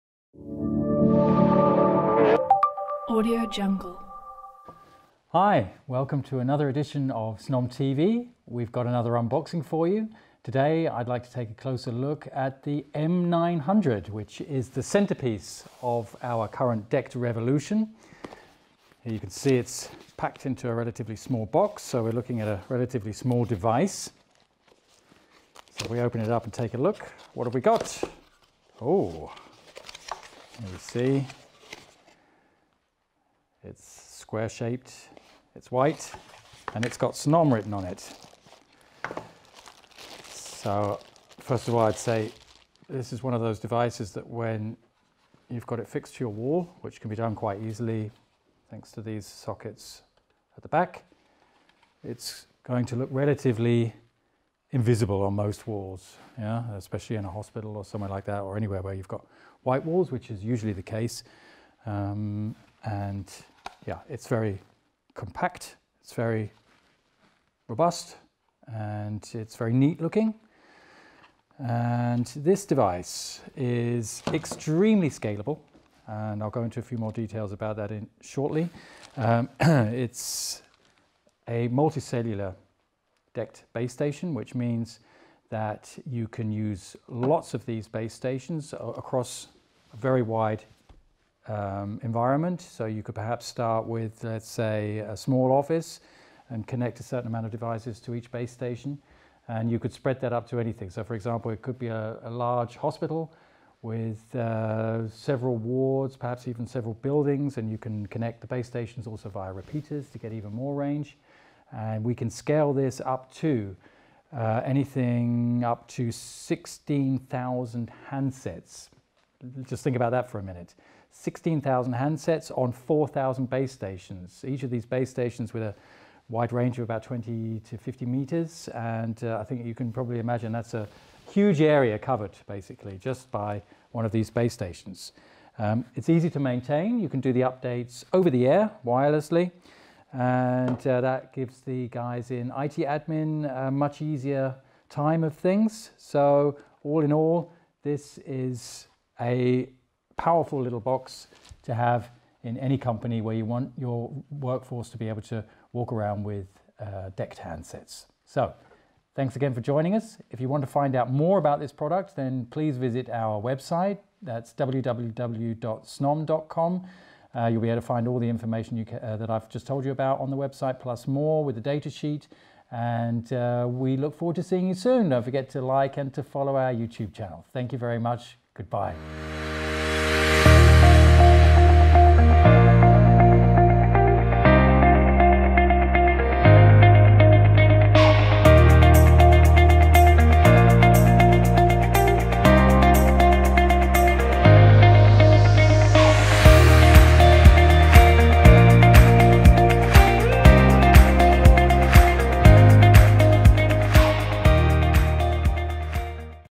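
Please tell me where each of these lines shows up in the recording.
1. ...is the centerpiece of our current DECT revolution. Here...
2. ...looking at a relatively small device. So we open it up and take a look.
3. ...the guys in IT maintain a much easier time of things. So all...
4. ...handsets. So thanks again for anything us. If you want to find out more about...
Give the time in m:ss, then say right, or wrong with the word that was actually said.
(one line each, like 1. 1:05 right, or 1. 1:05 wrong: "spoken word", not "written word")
1. 0:14 right
2. 0:22 right
3. 2:21 wrong: "admin", not "maintain"
4. 2:37 wrong: "joining", not "anything".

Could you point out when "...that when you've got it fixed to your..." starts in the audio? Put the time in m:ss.
0:44.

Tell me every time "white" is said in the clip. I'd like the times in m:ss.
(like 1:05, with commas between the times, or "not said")
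0:35, 0:59.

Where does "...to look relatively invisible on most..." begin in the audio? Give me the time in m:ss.
0:52.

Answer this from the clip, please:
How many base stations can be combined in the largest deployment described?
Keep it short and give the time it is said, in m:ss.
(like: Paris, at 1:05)
4,000, at 2:02.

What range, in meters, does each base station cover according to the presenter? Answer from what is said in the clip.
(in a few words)
20 to 50 meters.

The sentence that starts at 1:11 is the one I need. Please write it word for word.
And this device is extremely scalable, and I'll go into a few more details about that in shortly.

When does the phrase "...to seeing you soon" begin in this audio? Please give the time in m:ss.
2:54.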